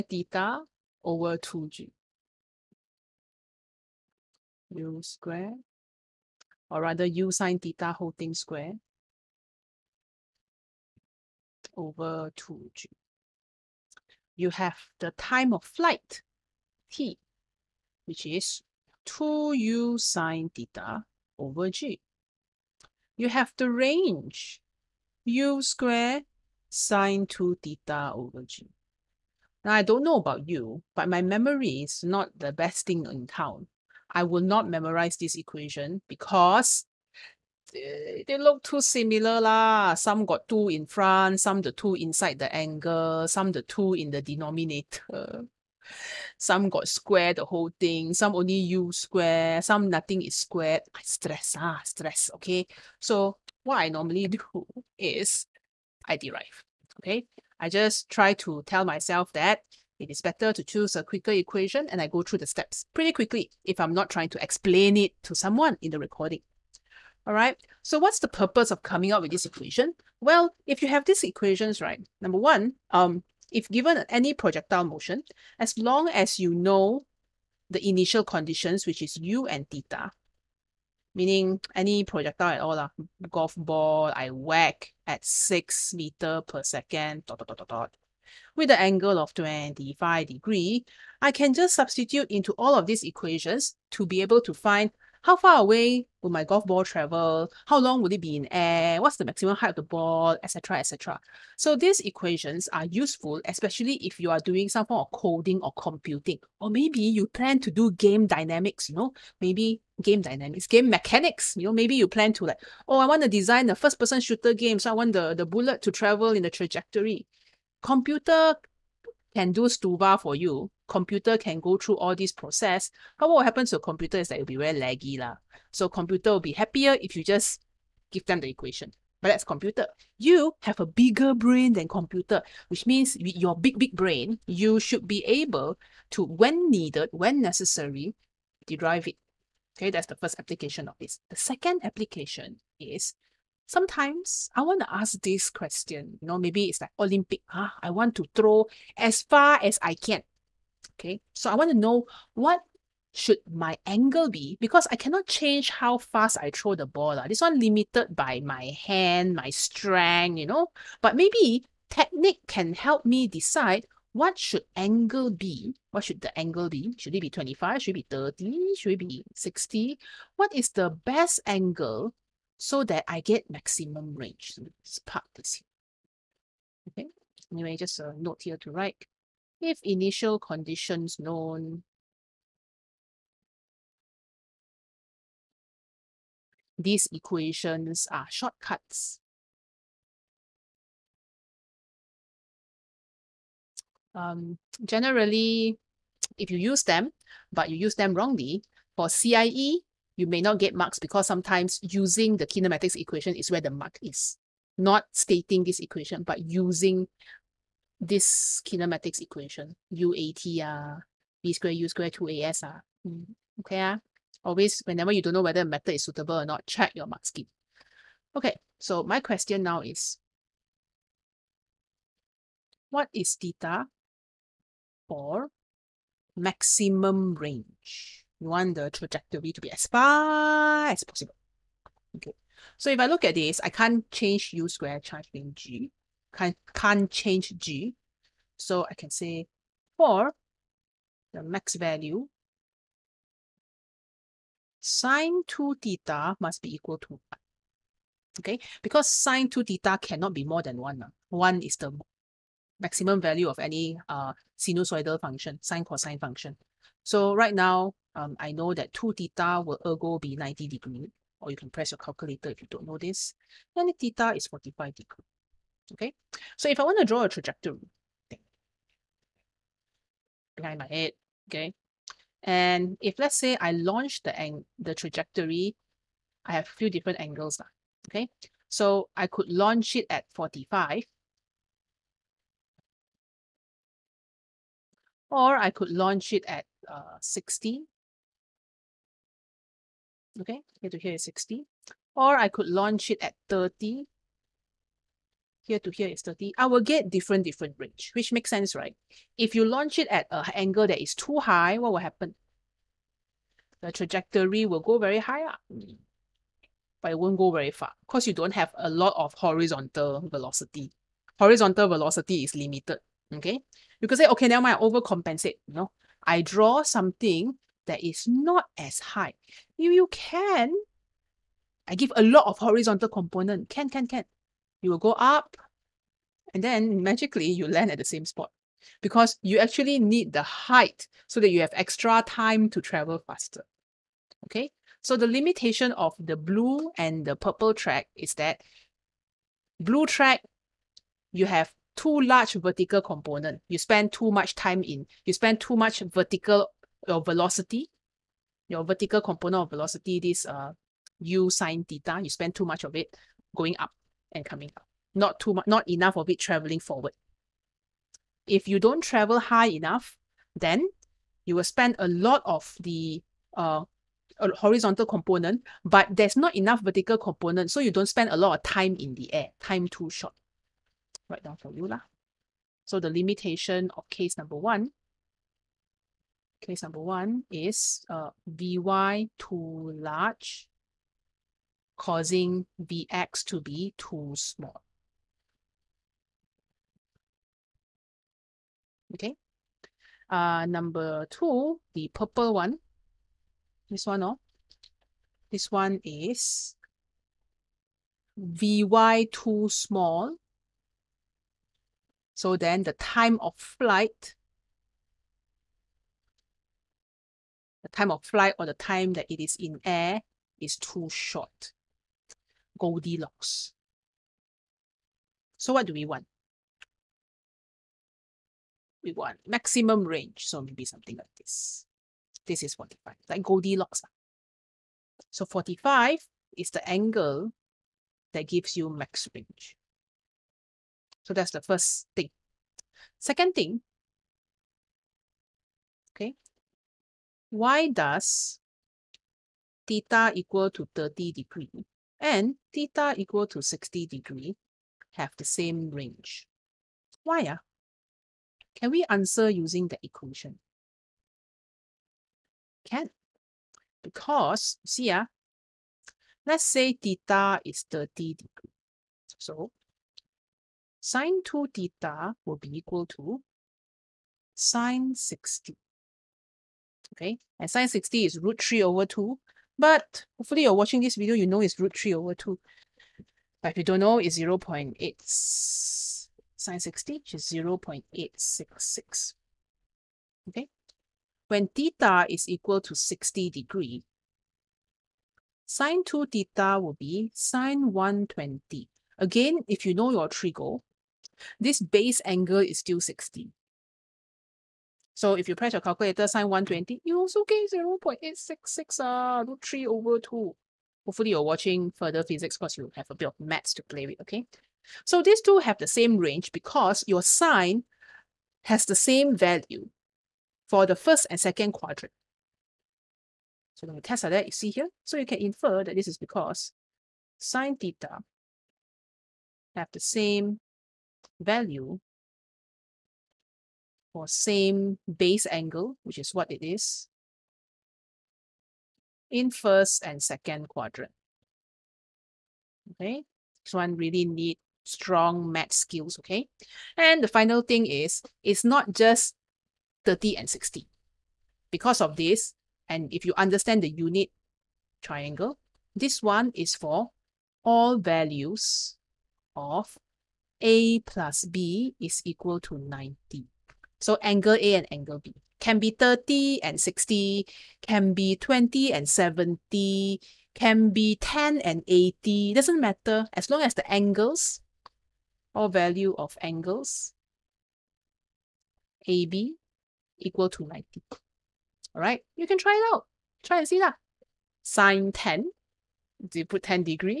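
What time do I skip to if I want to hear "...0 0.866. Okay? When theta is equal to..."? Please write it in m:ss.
7:57.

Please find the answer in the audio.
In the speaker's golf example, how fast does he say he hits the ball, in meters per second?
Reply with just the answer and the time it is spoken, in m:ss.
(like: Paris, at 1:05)
6 meters per second, at 1:25.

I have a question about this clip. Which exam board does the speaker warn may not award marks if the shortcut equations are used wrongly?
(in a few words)
CIE.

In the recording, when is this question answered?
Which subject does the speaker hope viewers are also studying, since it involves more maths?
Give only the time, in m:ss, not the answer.
8:21.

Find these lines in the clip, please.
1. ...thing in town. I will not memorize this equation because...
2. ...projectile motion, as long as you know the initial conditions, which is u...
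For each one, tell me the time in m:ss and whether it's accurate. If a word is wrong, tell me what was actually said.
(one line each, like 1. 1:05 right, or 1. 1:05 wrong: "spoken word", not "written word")
1. 0:32 right
2. 1:14 right.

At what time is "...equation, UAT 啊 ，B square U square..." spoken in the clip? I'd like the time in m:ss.
3:29.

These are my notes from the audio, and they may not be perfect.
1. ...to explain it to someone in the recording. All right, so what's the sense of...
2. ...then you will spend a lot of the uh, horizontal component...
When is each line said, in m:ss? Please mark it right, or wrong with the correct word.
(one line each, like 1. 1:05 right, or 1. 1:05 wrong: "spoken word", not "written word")
1. 1:04 wrong: "purpose", not "sense"
2. 6:00 right.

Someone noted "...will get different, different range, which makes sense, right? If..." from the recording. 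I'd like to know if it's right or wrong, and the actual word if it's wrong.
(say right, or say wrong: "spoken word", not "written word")
right.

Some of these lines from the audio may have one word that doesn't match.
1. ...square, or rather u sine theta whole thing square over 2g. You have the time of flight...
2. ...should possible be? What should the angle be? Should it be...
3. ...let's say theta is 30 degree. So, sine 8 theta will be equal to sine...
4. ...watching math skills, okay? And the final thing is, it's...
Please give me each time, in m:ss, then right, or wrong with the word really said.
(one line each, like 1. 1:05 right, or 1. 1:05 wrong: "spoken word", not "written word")
1. 0:05 right
2. 2:44 wrong: "angle", not "possible"
3. 7:36 wrong: "2", not "8"
4. 8:54 wrong: "strong", not "watching".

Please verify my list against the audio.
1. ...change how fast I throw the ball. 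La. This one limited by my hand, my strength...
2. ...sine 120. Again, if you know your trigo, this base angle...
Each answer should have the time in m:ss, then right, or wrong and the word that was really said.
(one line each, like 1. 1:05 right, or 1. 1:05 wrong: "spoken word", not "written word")
1. 2:35 right
2. 8:07 right.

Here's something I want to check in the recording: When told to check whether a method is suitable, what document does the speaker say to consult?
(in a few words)
mark scheme.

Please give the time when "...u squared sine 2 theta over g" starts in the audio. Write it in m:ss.
0:25.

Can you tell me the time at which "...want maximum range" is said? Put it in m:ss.
6:59.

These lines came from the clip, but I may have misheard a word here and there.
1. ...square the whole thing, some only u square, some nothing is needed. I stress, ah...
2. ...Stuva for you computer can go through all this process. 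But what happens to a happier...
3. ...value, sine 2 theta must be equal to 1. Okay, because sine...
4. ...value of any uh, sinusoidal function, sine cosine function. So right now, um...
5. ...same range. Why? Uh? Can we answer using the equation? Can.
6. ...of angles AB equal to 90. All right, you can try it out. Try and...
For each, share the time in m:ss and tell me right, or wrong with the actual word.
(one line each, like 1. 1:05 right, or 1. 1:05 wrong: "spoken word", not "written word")
1. 0:46 wrong: "squared", not "needed"
2. 1:59 wrong: "computer", not "happier"
3. 4:01 right
4. 4:13 right
5. 7:25 right
6. 9:26 right.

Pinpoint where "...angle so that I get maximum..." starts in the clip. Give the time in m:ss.
2:51.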